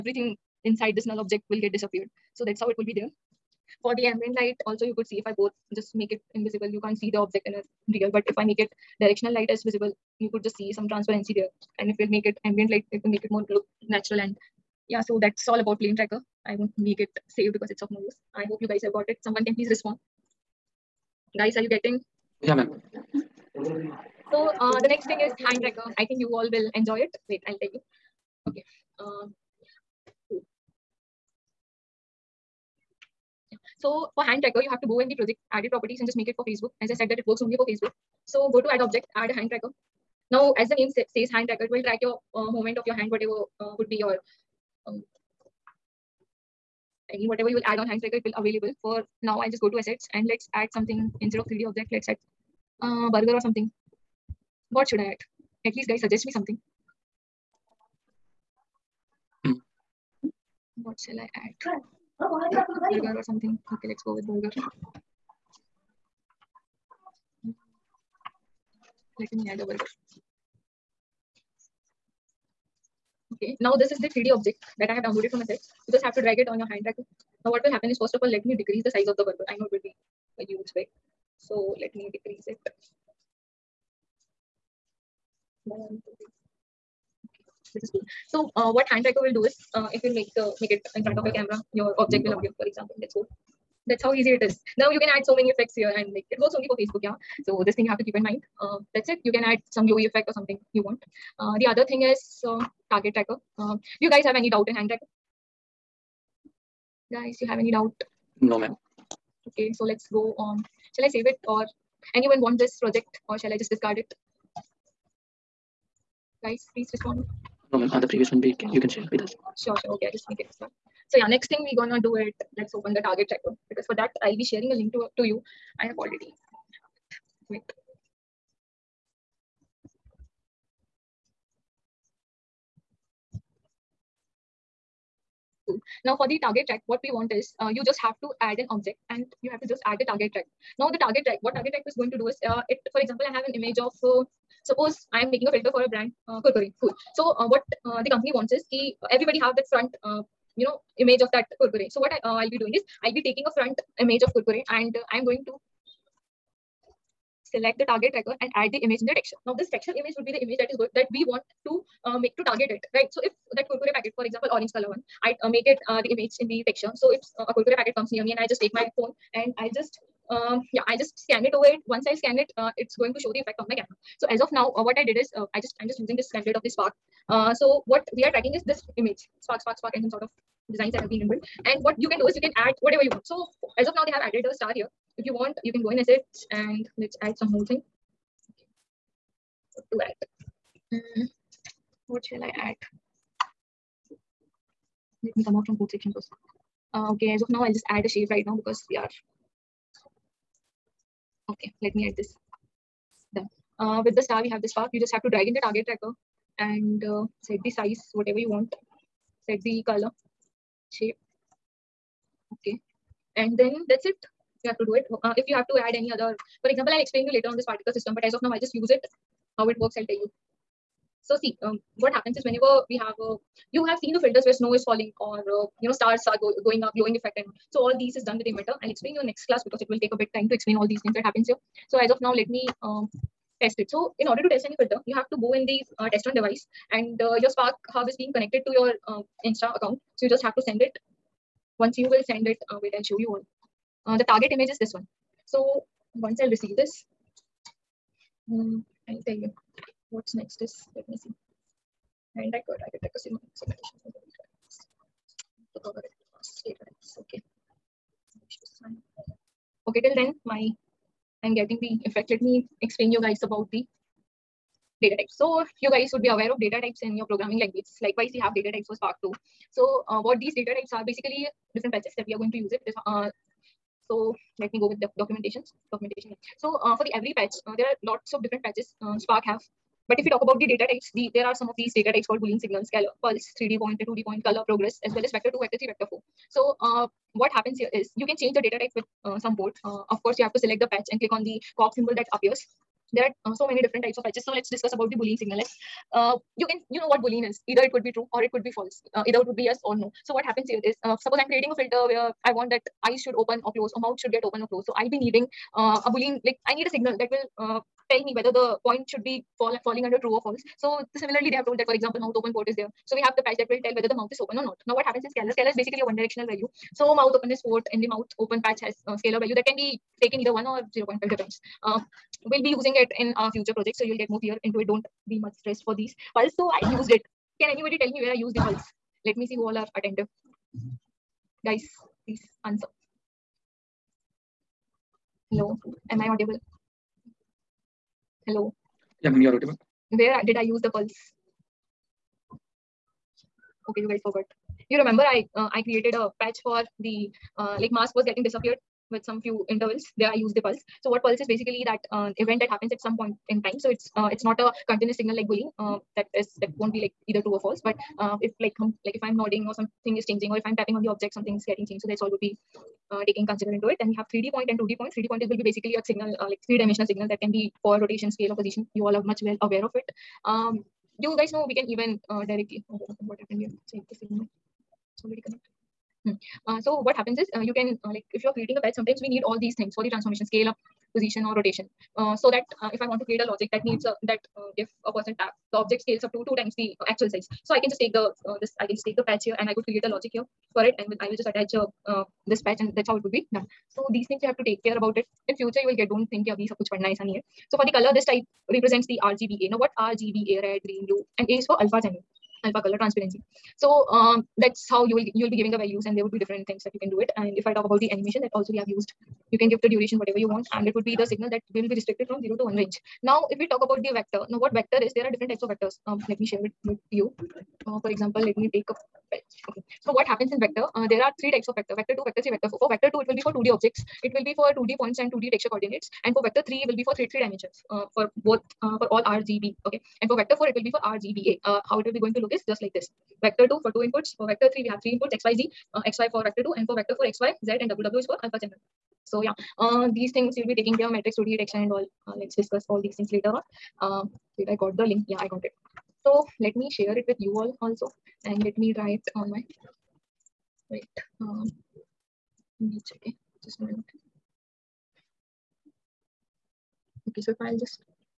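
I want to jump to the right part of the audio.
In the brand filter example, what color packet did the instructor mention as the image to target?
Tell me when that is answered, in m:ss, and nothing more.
2:44.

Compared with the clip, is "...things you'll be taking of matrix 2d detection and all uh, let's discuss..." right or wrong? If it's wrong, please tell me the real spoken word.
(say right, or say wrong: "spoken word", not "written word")
right.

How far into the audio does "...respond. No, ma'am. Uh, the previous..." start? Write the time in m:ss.
1:56.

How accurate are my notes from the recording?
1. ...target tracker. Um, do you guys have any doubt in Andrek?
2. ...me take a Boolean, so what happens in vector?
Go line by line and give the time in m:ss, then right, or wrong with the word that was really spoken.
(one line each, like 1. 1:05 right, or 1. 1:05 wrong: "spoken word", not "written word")
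1. 1:42 right
2. 6:58 wrong: "Okay", not "Boolean".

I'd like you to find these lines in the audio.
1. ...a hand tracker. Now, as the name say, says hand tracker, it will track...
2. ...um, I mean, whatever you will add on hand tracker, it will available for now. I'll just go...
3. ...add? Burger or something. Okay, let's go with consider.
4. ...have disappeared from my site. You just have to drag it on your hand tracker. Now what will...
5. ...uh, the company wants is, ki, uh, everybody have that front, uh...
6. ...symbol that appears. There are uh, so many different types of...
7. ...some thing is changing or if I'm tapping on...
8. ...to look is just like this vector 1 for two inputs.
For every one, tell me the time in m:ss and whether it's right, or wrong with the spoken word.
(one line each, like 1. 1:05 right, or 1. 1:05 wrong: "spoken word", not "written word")
1. 0:39 right
2. 0:44 right
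3. 1:01 wrong: "burger", not "consider"
4. 1:14 wrong: "downloaded", not "disappeared"
5. 2:27 right
6. 4:51 right
7. 5:59 right
8. 7:12 wrong: "2", not "1".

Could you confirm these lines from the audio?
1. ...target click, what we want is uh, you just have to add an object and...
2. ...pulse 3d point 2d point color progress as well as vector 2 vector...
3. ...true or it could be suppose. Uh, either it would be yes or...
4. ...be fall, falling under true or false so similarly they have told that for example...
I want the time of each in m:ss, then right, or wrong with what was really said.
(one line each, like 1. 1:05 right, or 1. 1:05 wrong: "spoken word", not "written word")
1. 2:16 wrong: "check", not "click"
2. 4:43 right
3. 4:58 wrong: "false", not "suppose"
4. 5:09 right.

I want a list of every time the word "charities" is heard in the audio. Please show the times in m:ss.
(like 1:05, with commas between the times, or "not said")
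not said.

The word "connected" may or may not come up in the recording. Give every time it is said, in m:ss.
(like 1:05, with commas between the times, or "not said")
3:58, 6:15.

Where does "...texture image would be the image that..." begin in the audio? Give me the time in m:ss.
2:39.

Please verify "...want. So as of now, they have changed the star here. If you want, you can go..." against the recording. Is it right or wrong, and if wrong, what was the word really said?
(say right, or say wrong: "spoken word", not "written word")
wrong: "added", not "changed".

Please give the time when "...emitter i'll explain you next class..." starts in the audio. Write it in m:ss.
3:48.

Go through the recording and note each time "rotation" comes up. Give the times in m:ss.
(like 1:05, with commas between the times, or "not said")
6:07, 6:21.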